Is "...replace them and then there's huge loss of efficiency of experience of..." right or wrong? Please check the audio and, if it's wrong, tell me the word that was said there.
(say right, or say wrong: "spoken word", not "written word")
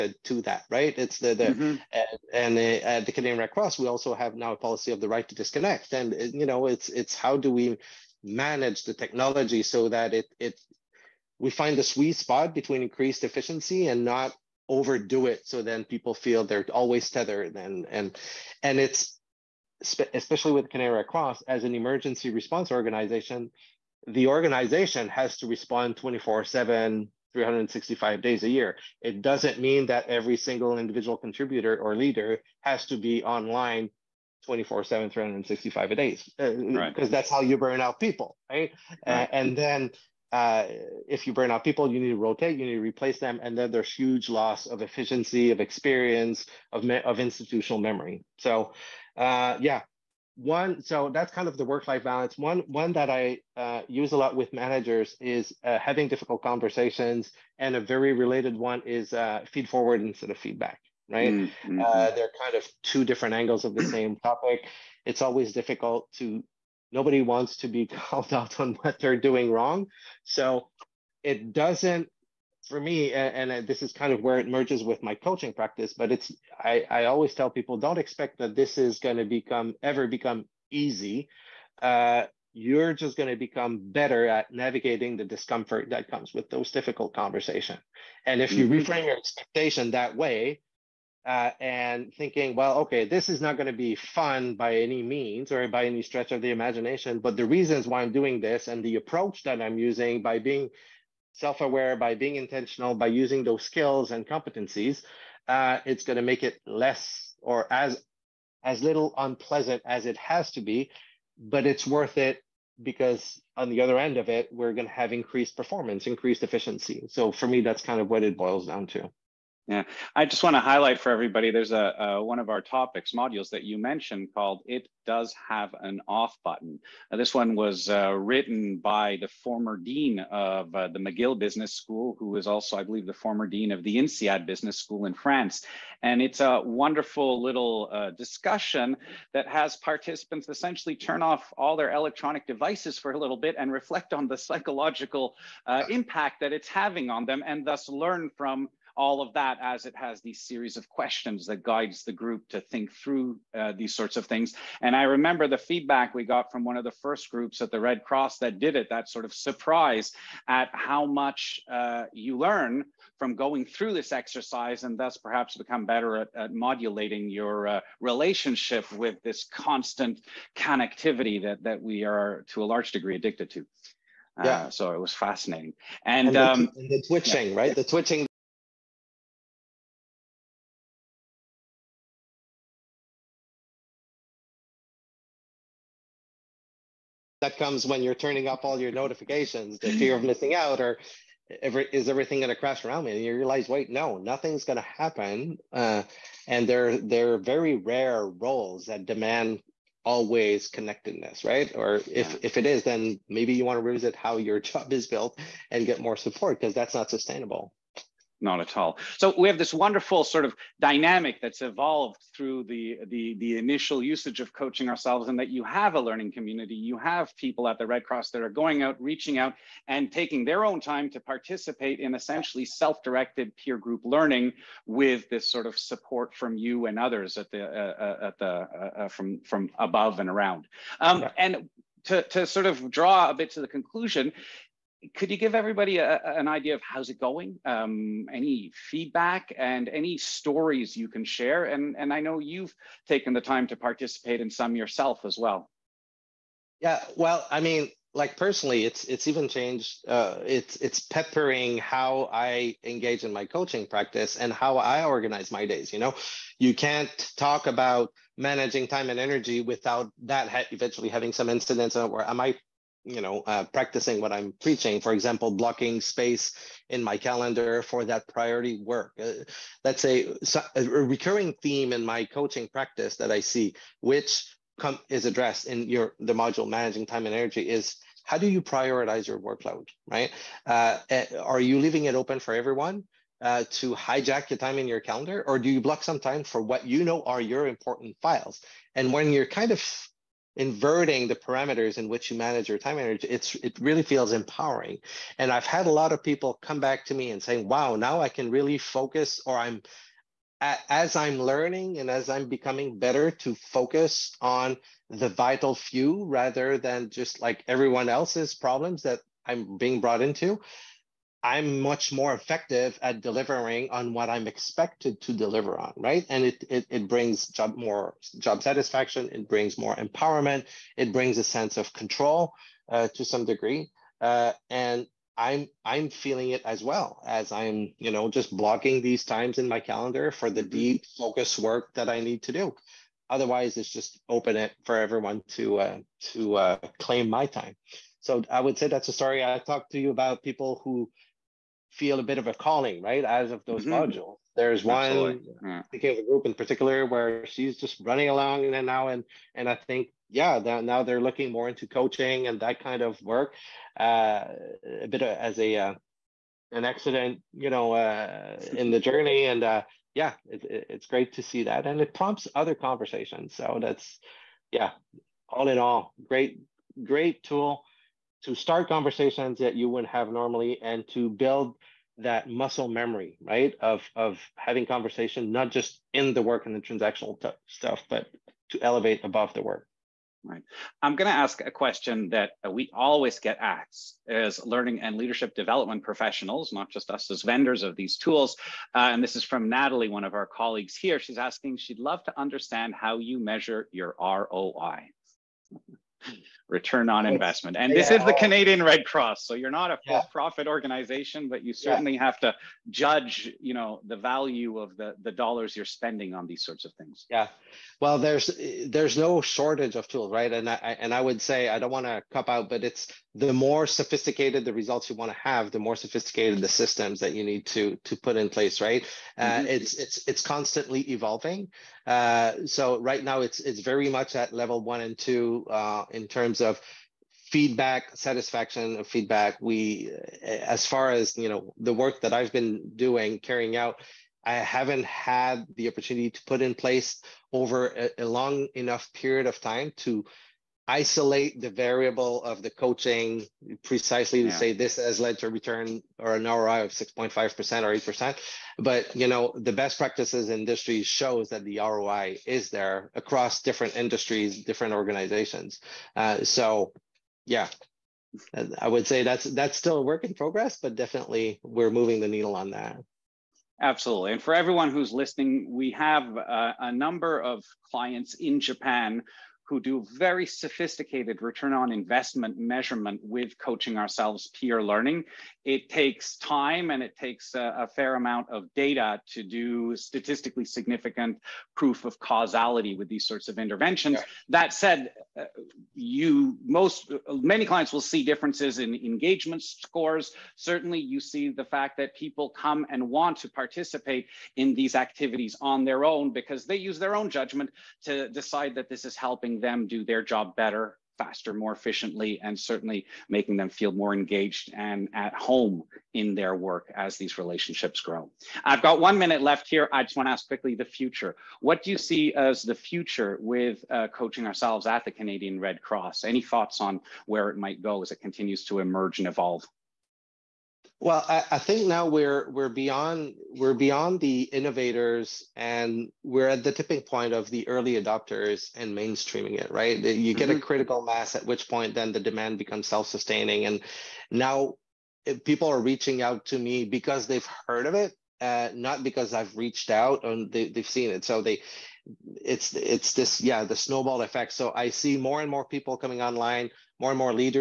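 right.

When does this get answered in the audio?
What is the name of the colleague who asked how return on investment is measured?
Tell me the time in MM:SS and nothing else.
06:29.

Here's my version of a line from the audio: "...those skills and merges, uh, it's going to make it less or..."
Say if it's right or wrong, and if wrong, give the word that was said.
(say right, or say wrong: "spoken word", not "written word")
wrong: "competencies", not "merges".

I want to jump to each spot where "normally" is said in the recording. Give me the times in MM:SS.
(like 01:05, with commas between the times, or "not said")
06:10.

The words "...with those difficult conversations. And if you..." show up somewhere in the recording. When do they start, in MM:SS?
01:26.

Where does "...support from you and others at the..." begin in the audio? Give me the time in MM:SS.
03:45.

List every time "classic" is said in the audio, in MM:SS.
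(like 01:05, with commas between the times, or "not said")
not said.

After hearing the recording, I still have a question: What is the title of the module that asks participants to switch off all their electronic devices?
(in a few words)
It Does Have an Off Button.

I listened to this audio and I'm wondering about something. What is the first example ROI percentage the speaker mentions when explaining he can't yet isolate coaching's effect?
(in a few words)
6.5%.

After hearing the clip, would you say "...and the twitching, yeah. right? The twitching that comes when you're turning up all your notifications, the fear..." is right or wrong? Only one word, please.
right.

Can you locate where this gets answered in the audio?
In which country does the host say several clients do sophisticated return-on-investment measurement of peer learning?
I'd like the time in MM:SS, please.
07:48.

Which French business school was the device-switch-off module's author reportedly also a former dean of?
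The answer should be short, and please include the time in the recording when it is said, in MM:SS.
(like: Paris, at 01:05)
INSEAD, at 02:13.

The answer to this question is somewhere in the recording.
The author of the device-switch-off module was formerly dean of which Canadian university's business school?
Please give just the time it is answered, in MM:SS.
02:10.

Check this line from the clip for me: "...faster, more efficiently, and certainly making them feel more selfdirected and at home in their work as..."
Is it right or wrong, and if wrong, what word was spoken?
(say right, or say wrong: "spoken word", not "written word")
wrong: "engaged", not "selfdirected".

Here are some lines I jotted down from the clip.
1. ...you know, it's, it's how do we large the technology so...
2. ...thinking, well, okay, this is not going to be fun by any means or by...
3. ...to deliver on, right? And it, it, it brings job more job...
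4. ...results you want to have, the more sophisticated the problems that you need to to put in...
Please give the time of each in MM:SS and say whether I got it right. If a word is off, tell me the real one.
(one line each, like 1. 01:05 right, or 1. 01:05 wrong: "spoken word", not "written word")
1. 00:06 wrong: "manage", not "large"
2. 01:32 right
3. 05:15 right
4. 06:54 wrong: "systems", not "problems".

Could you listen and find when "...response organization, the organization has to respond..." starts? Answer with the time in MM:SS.
00:22.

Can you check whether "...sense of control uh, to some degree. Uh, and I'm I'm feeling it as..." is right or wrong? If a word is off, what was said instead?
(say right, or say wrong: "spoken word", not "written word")
right.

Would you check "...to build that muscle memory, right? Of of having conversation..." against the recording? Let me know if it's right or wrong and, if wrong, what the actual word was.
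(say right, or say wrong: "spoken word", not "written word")
right.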